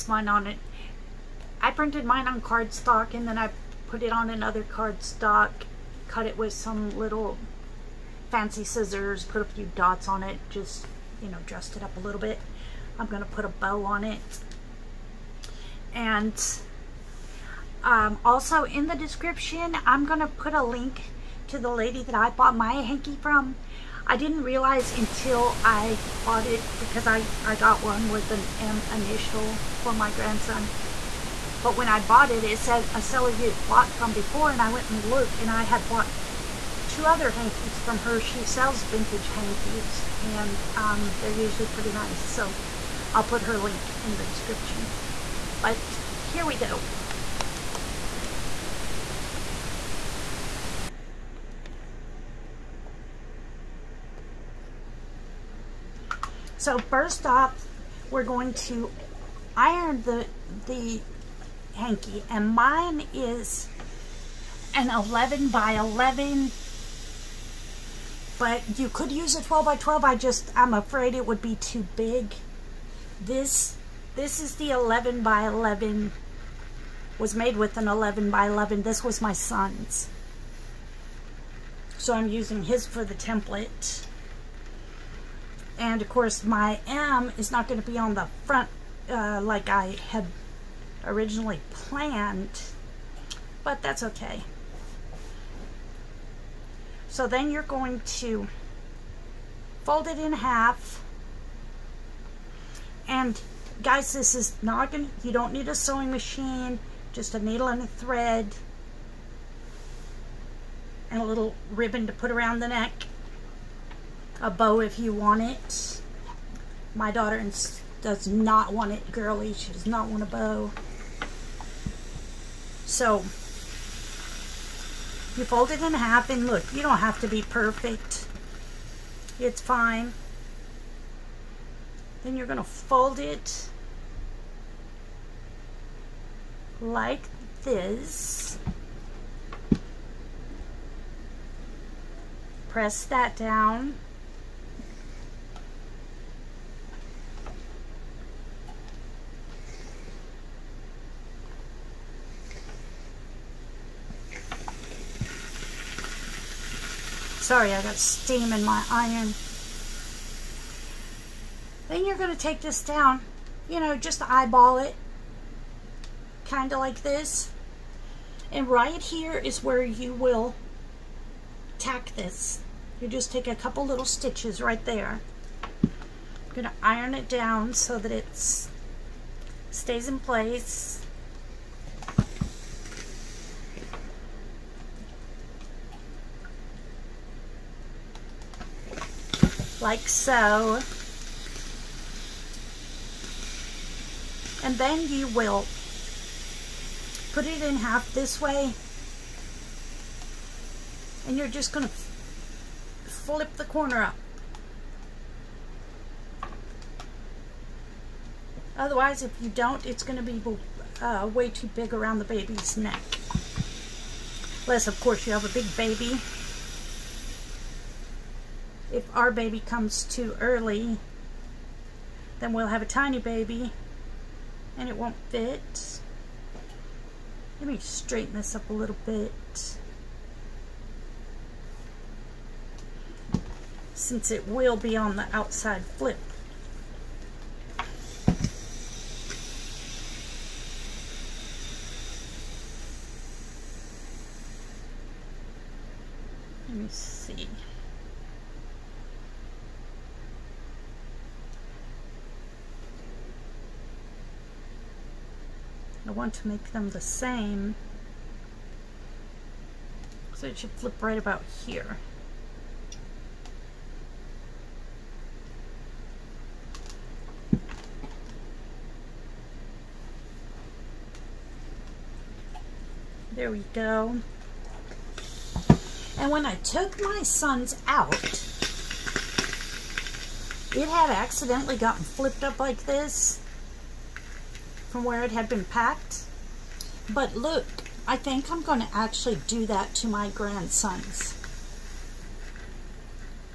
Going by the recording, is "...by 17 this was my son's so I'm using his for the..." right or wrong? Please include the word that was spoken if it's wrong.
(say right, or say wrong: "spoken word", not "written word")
wrong: "11", not "17".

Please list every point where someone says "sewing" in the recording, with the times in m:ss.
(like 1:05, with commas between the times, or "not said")
1:45.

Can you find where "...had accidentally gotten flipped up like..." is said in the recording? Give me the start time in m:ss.
4:40.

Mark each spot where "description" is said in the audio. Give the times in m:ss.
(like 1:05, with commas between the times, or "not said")
0:18, 0:44.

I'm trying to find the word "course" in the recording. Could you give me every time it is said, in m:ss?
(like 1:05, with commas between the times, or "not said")
1:26, 3:35.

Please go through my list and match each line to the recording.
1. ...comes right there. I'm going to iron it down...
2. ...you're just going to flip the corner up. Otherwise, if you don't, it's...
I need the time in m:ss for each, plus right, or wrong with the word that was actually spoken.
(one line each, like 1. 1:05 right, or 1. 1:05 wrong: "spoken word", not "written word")
1. 2:54 wrong: "stitches", not "comes"
2. 3:21 right.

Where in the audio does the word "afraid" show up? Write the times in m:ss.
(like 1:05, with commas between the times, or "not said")
1:10.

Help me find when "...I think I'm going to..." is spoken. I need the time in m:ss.
4:48.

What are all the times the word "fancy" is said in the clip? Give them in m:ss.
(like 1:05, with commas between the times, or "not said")
0:08.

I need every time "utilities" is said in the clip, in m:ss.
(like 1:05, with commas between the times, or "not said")
not said.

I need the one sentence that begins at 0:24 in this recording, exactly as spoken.
I didn't realize until I bought it because I, I got one with an M initial for my grandson.